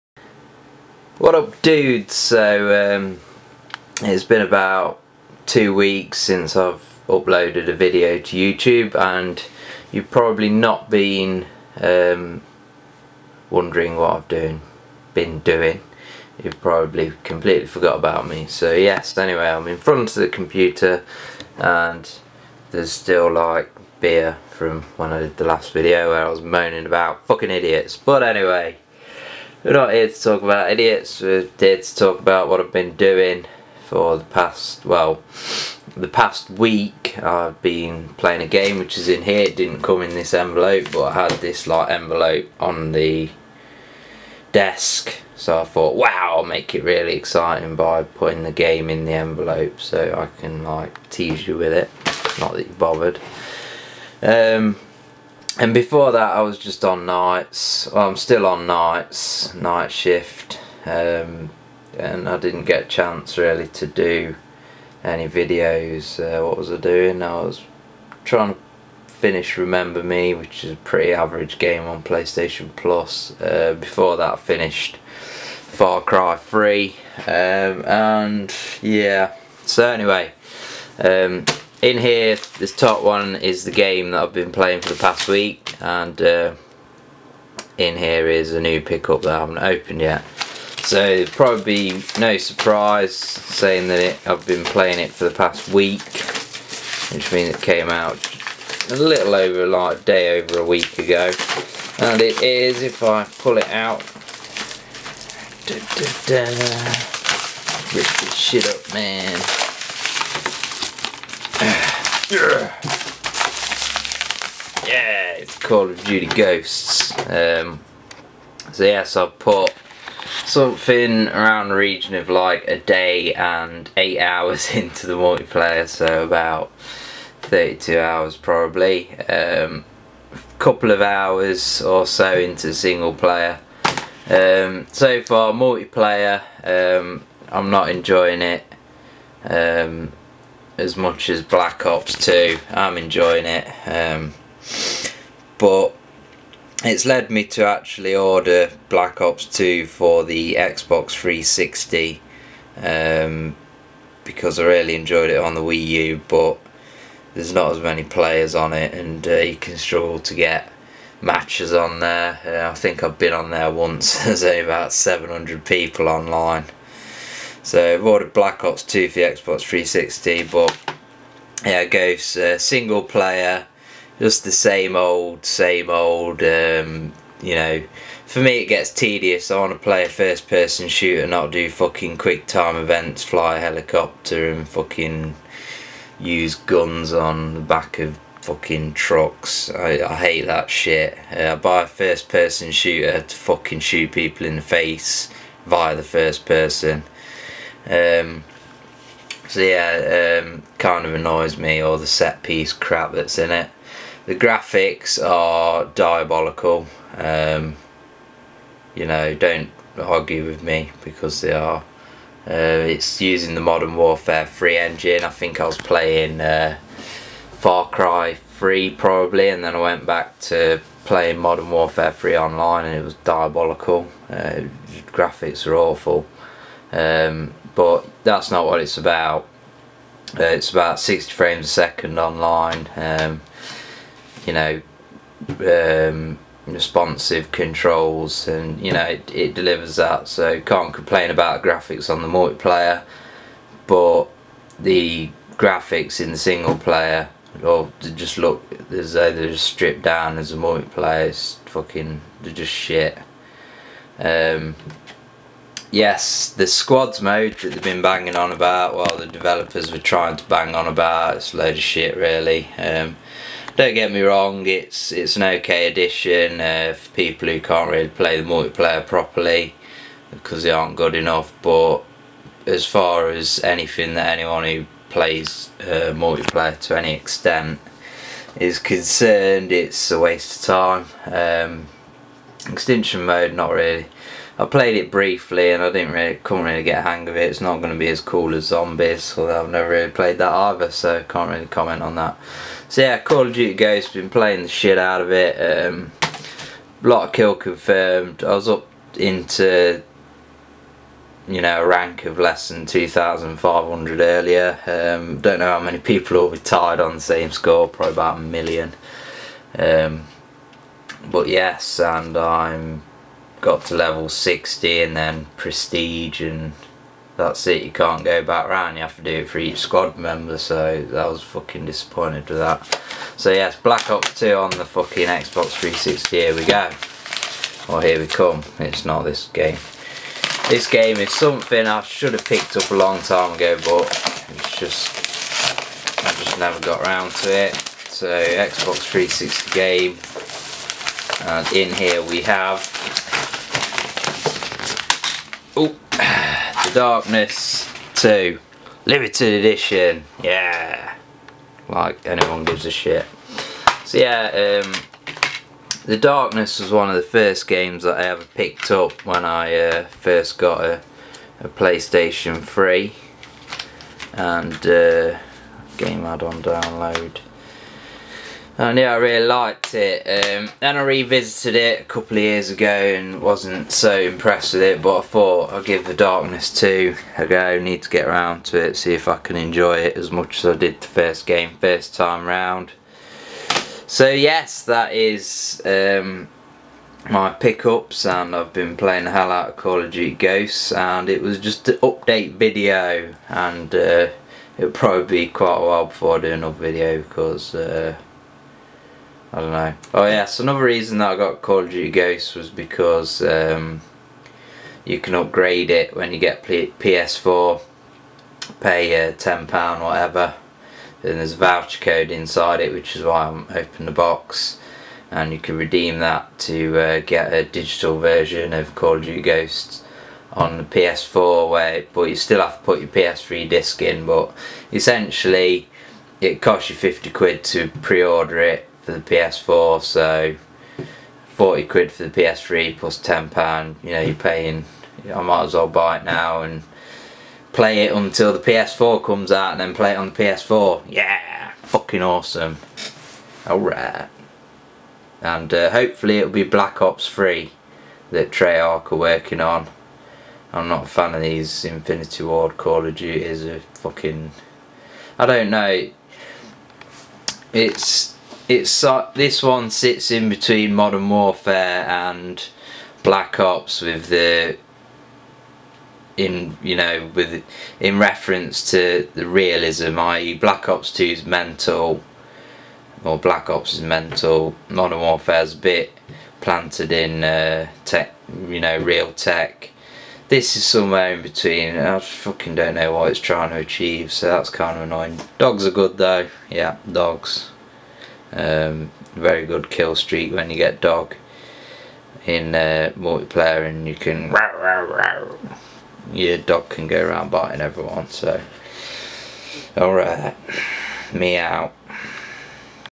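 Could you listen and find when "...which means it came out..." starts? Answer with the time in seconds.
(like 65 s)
97 s.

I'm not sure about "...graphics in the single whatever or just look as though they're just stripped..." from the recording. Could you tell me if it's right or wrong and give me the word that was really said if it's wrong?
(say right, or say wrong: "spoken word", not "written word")
wrong: "player", not "whatever".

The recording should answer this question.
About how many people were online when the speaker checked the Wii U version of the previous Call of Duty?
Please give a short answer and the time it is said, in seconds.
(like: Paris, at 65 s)
700, at 164 s.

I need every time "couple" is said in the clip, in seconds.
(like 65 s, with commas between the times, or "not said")
130 s, 372 s.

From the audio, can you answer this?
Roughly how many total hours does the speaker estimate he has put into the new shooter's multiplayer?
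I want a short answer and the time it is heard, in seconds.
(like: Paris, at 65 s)
32, at 127 s.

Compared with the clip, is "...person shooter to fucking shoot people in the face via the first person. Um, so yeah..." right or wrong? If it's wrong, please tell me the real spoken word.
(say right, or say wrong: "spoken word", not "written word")
right.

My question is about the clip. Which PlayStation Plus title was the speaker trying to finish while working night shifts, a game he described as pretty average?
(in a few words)
Remember Me.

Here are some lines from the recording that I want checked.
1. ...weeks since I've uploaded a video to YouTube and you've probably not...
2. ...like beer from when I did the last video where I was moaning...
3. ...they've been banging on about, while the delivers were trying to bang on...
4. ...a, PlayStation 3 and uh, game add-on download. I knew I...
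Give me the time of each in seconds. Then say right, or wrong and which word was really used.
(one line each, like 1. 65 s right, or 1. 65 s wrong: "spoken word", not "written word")
1. 5 s right
2. 23 s right
3. 257 s wrong: "developers", not "delivers"
4. 361 s right.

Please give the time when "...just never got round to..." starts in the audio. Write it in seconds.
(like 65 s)
336 s.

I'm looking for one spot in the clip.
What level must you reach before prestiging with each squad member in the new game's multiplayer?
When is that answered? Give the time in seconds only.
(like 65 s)
313 s.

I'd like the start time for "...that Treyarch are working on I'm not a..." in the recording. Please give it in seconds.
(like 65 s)
448 s.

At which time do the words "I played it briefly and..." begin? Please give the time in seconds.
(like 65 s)
284 s.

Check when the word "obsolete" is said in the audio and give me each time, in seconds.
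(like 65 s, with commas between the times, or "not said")
not said.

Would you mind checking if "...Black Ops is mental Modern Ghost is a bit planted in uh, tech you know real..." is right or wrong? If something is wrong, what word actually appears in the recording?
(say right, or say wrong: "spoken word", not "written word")
wrong: "Warfare", not "Ghost".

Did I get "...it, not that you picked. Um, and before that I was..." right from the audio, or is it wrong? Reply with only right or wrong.
wrong.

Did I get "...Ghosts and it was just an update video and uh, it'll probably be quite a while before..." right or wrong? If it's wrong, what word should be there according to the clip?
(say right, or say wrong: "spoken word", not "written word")
right.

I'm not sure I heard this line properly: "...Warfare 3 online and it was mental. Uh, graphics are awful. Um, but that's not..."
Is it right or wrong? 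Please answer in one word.
wrong.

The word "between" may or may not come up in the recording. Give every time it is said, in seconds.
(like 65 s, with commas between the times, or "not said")
460 s, 481 s.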